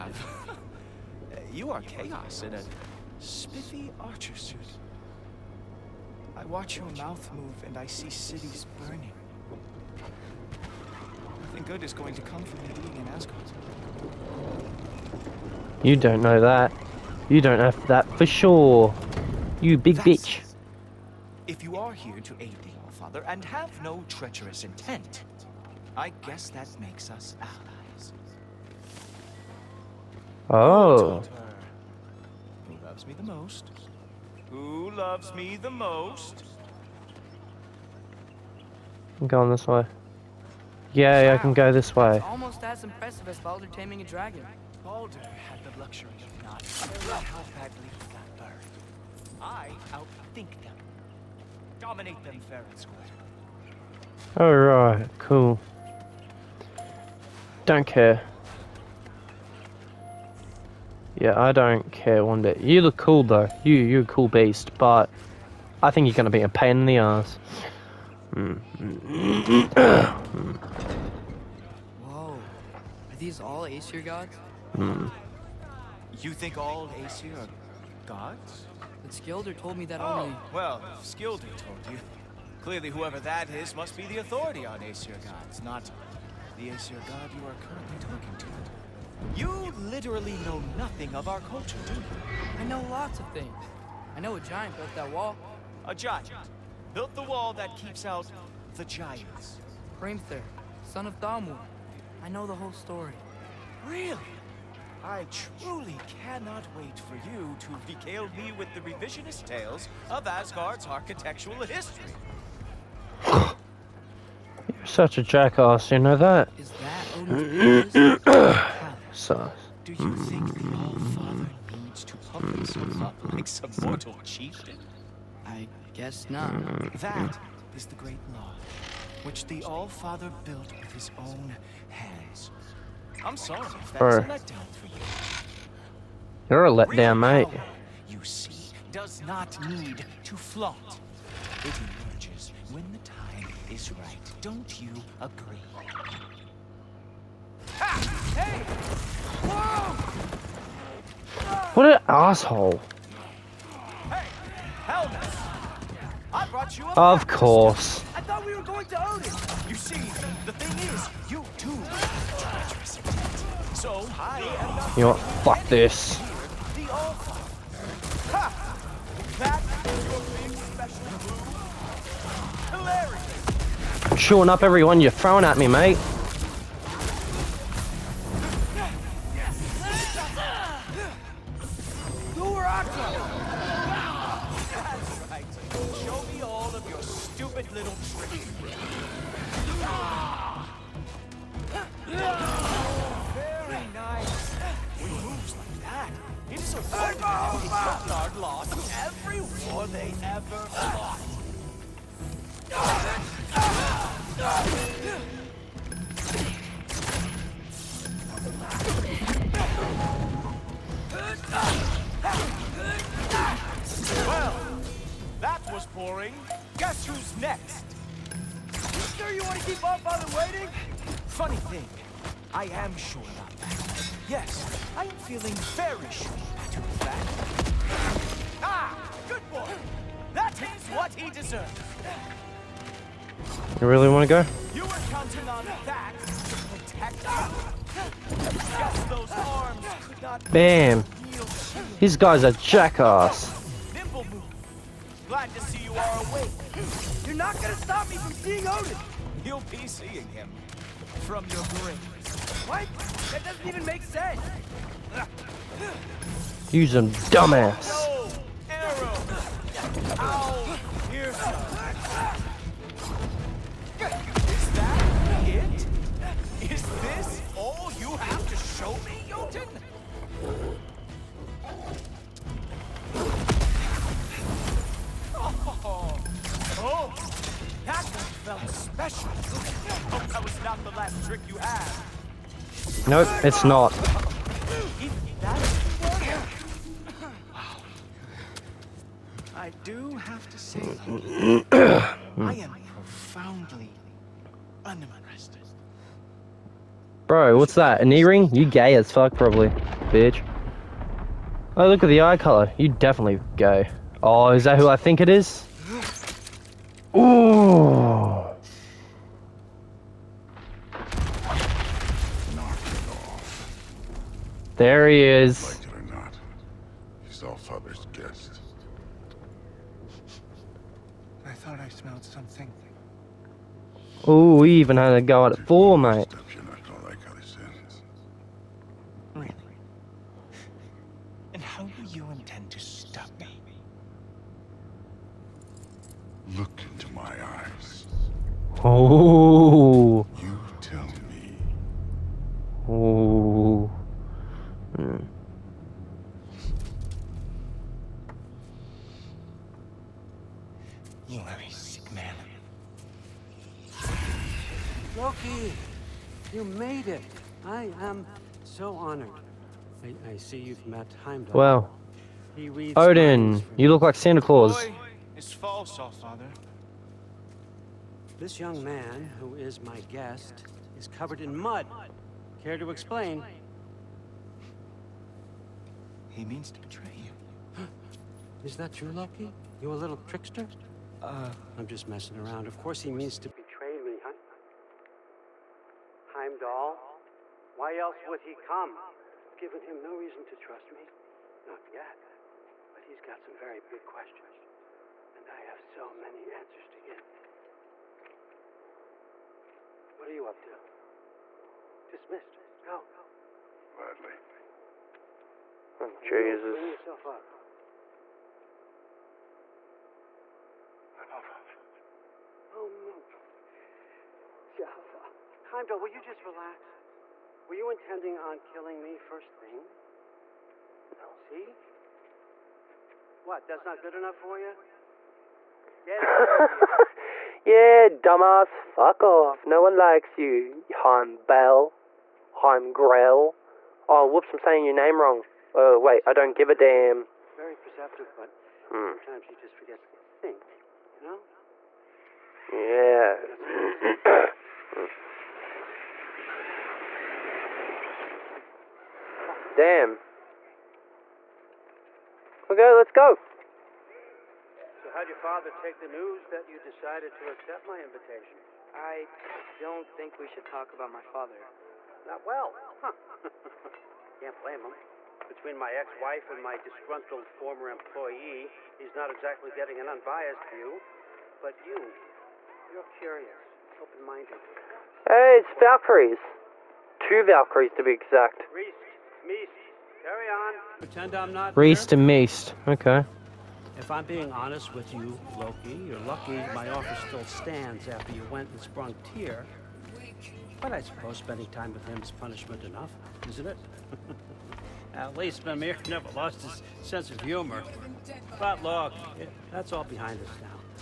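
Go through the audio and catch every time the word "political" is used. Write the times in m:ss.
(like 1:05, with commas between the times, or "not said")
not said.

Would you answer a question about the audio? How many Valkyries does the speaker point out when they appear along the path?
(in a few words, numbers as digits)
2.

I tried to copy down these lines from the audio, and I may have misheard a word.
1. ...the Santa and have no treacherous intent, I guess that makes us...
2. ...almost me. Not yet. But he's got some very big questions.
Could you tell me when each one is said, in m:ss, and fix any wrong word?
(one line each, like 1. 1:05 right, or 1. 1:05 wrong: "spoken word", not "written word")
1. 0:22 wrong: "Allfather", not "Santa"
2. 6:30 wrong: "trust", not "almost".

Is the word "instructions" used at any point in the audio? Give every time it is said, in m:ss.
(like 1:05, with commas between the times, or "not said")
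not said.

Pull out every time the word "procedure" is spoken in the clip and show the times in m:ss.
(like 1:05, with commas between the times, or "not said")
not said.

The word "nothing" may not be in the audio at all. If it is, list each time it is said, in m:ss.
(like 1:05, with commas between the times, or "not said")
0:11, 1:30.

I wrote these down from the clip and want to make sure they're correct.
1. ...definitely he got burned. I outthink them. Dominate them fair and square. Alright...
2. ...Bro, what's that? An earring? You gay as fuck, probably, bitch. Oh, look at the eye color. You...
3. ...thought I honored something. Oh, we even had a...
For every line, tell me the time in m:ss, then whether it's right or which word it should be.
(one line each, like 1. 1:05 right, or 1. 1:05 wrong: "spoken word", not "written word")
1. 0:47 wrong: "badly", not "definitely"
2. 4:57 right
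3. 5:21 wrong: "smelled", not "honored".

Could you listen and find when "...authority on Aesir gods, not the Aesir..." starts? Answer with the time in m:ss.
1:24.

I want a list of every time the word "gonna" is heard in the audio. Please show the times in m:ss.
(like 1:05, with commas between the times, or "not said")
1:06, 4:07.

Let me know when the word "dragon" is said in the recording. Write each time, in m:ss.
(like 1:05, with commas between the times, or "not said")
0:44.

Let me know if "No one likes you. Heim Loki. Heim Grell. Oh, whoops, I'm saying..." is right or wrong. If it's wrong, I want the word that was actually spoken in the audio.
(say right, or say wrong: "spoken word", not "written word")
wrong: "Bell", not "Loki".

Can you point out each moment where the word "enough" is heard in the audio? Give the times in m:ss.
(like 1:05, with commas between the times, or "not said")
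6:47, 7:04, 8:12.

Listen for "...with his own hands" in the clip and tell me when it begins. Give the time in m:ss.
2:10.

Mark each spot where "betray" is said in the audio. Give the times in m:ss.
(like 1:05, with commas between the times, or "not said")
6:16, 6:23.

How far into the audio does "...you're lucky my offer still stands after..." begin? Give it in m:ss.
8:06.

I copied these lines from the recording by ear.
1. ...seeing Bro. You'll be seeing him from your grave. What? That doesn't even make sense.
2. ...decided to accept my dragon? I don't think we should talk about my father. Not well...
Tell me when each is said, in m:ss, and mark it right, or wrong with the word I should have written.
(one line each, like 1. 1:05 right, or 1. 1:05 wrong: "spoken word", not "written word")
1. 4:08 wrong: "Odin", not "Bro"
2. 7:36 wrong: "invitation", not "dragon".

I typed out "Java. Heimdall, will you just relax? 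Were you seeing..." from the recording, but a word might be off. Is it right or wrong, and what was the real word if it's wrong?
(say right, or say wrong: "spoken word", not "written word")
wrong: "intending", not "seeing".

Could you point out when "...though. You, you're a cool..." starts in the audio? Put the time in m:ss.
1:03.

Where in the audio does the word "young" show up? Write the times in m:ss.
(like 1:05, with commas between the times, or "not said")
6:08.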